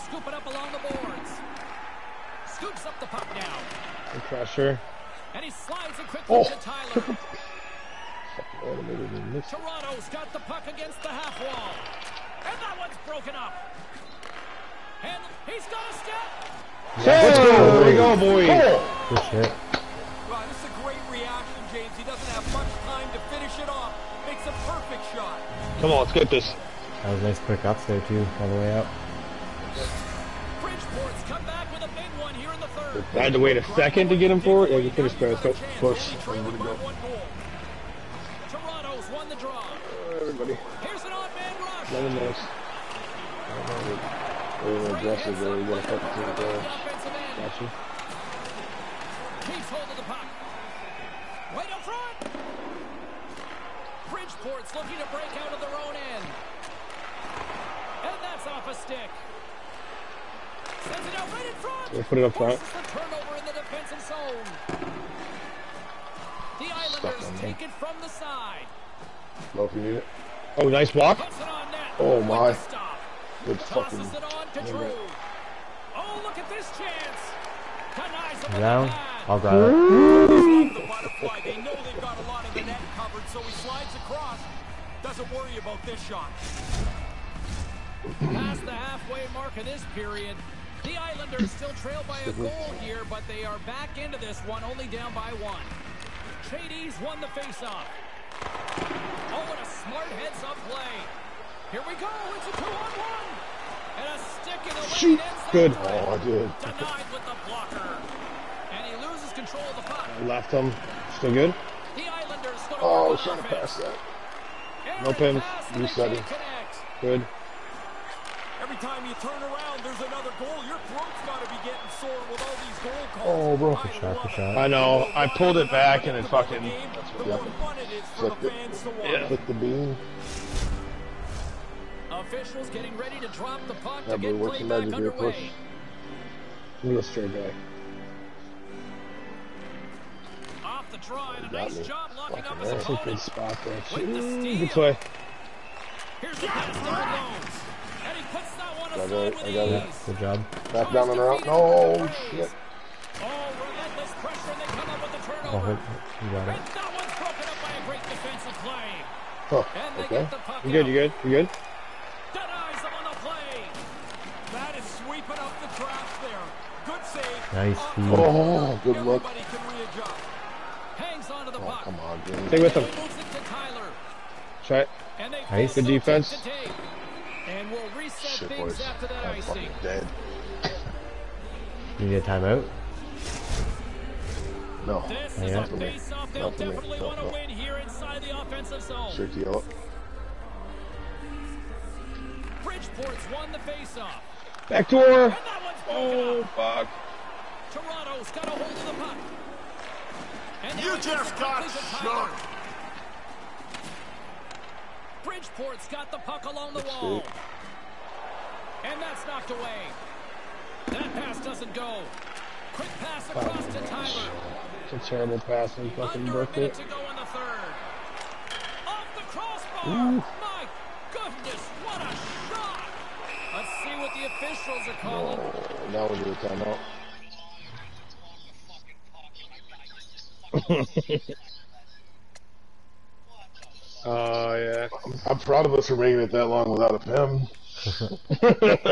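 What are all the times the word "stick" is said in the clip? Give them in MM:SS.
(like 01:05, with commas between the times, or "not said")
00:58, 01:44.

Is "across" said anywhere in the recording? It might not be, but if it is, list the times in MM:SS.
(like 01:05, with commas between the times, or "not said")
01:23, 03:33.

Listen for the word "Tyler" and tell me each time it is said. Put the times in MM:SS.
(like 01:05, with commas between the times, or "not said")
00:06, 03:33.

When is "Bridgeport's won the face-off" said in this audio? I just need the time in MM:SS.
03:12.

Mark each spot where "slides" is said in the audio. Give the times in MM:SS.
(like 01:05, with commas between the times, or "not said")
00:05, 01:23.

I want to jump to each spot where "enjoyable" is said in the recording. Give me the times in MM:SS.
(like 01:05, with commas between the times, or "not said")
not said.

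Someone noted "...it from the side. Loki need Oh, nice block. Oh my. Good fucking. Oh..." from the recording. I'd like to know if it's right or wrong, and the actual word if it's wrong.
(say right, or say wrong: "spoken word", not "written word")
right.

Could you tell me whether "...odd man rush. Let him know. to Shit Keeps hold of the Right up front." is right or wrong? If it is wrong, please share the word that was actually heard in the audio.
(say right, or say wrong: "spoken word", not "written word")
wrong: "Got", not "Shit".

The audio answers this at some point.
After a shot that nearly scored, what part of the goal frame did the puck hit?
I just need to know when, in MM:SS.
03:38.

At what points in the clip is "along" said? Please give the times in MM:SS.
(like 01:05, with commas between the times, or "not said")
00:00, 03:26.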